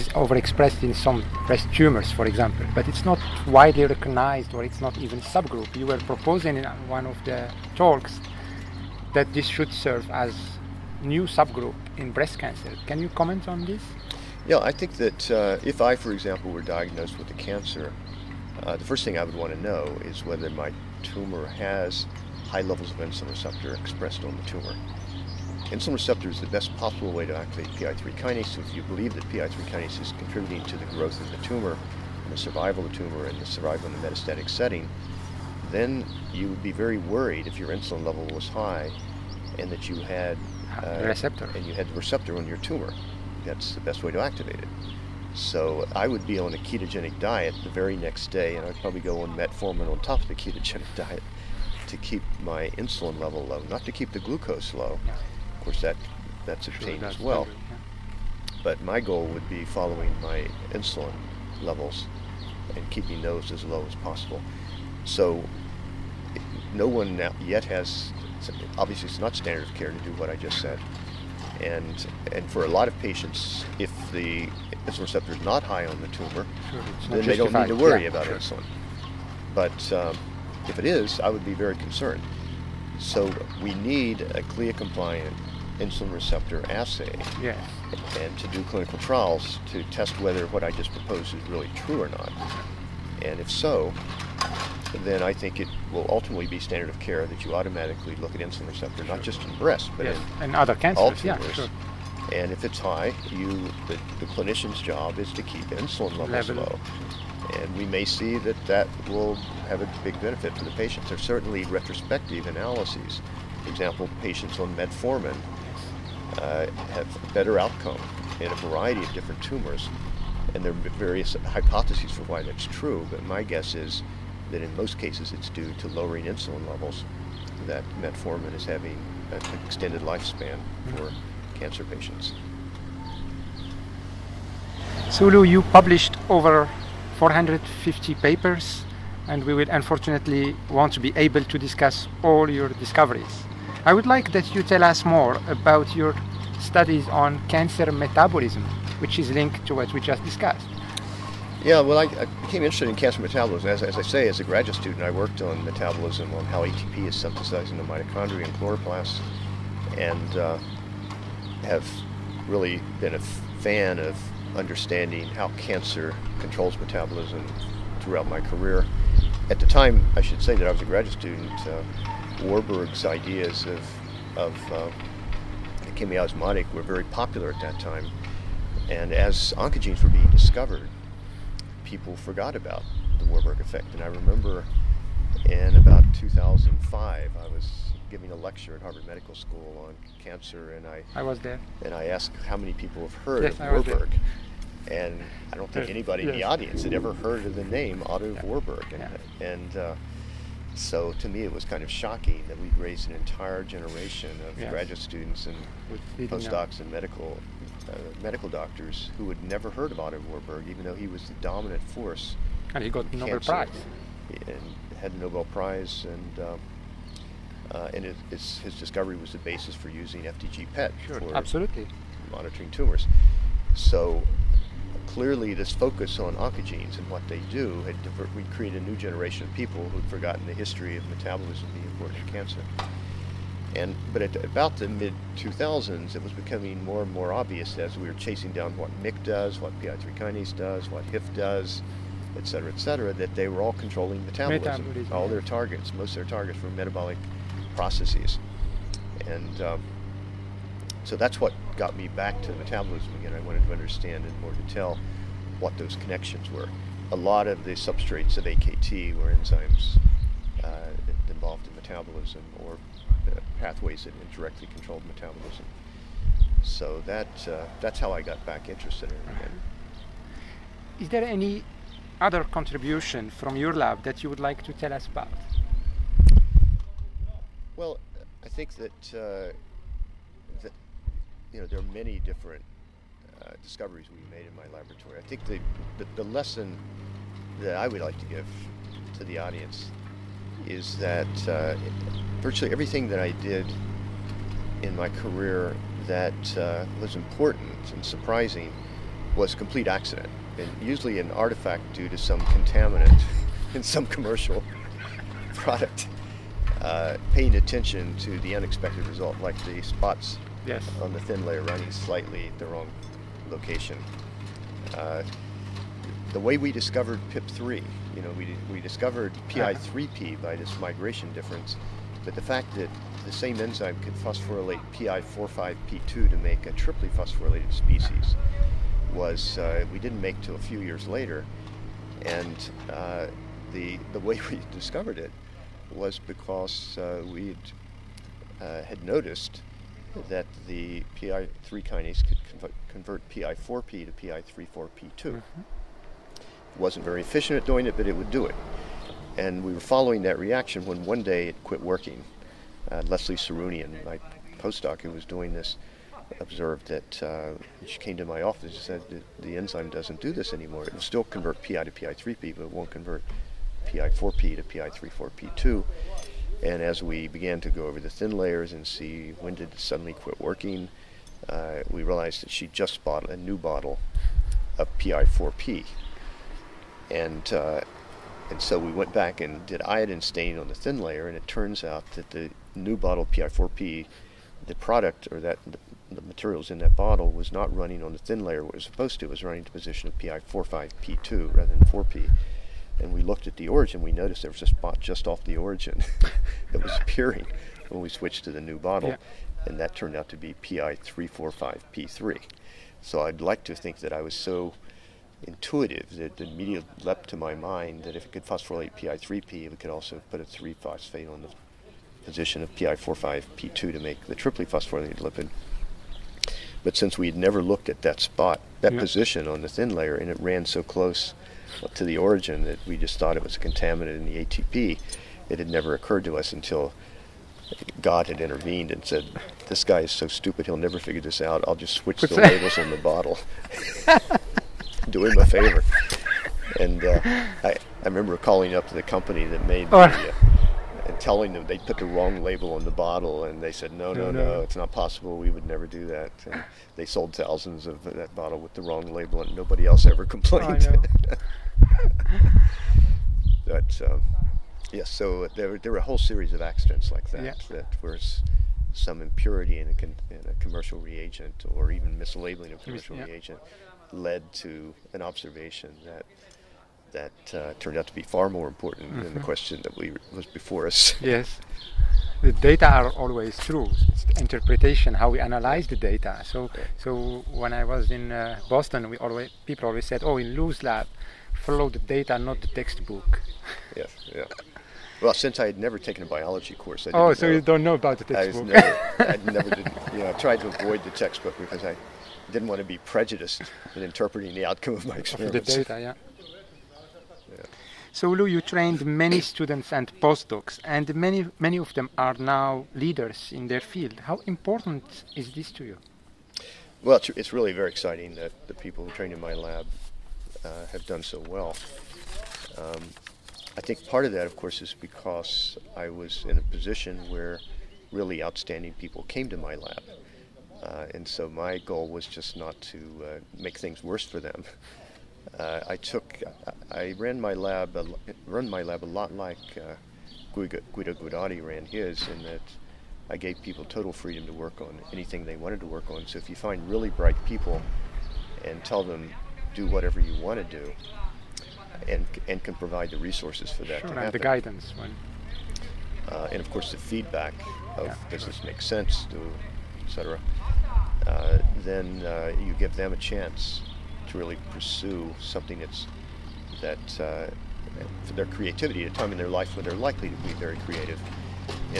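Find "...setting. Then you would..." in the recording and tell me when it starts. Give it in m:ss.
0:34.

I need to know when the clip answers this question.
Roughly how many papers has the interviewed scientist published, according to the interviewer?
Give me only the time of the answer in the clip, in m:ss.
2:17.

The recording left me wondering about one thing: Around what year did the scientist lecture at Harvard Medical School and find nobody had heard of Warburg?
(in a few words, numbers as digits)
2005.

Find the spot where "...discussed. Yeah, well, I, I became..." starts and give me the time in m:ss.
2:30.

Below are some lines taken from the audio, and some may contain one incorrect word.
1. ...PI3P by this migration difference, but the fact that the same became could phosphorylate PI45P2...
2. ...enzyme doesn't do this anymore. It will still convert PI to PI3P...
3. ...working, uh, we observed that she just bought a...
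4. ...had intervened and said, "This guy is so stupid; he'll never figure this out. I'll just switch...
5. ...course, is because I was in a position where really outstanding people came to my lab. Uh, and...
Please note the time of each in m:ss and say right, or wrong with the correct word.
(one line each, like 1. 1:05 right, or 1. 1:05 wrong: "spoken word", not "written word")
1. 5:19 wrong: "enzyme", not "became"
2. 5:59 right
3. 6:10 wrong: "realized", not "observed"
4. 7:08 right
5. 8:34 right.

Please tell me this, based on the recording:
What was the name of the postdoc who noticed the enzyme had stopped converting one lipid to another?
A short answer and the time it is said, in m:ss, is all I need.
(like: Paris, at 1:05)
Leslie Serunian, at 5:53.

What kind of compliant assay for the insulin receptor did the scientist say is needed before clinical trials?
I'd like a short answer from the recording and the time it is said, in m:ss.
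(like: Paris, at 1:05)
CLIA, at 1:24.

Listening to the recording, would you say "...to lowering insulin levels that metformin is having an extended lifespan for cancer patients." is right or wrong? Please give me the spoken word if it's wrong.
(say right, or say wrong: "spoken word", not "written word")
right.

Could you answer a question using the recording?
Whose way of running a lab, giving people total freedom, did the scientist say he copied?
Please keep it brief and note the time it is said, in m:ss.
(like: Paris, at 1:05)
Guido Guidotti, at 8:50.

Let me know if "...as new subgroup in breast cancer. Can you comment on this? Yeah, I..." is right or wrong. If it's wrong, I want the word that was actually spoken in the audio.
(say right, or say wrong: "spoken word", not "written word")
right.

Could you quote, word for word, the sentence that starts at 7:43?
reagent led to an observation that that uh, turned out to be far more important mm-hmm.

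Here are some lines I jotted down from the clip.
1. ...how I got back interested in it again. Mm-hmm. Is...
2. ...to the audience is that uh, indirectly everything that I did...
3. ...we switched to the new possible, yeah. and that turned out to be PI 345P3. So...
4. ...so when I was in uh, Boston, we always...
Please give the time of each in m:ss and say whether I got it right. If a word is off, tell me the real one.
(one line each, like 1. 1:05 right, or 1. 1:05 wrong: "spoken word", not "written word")
1. 4:28 right
2. 4:49 wrong: "virtually", not "indirectly"
3. 6:38 wrong: "bottle", not "possible"
4. 7:56 right.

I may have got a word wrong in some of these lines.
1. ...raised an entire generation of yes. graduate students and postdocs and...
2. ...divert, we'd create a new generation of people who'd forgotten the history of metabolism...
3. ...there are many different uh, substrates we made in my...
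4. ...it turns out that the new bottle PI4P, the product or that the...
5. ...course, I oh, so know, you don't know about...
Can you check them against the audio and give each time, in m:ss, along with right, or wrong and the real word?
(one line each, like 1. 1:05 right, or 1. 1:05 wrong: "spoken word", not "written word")
1. 3:22 right
2. 3:48 right
3. 4:41 wrong: "discoveries", not "substrates"
4. 6:21 right
5. 8:06 right.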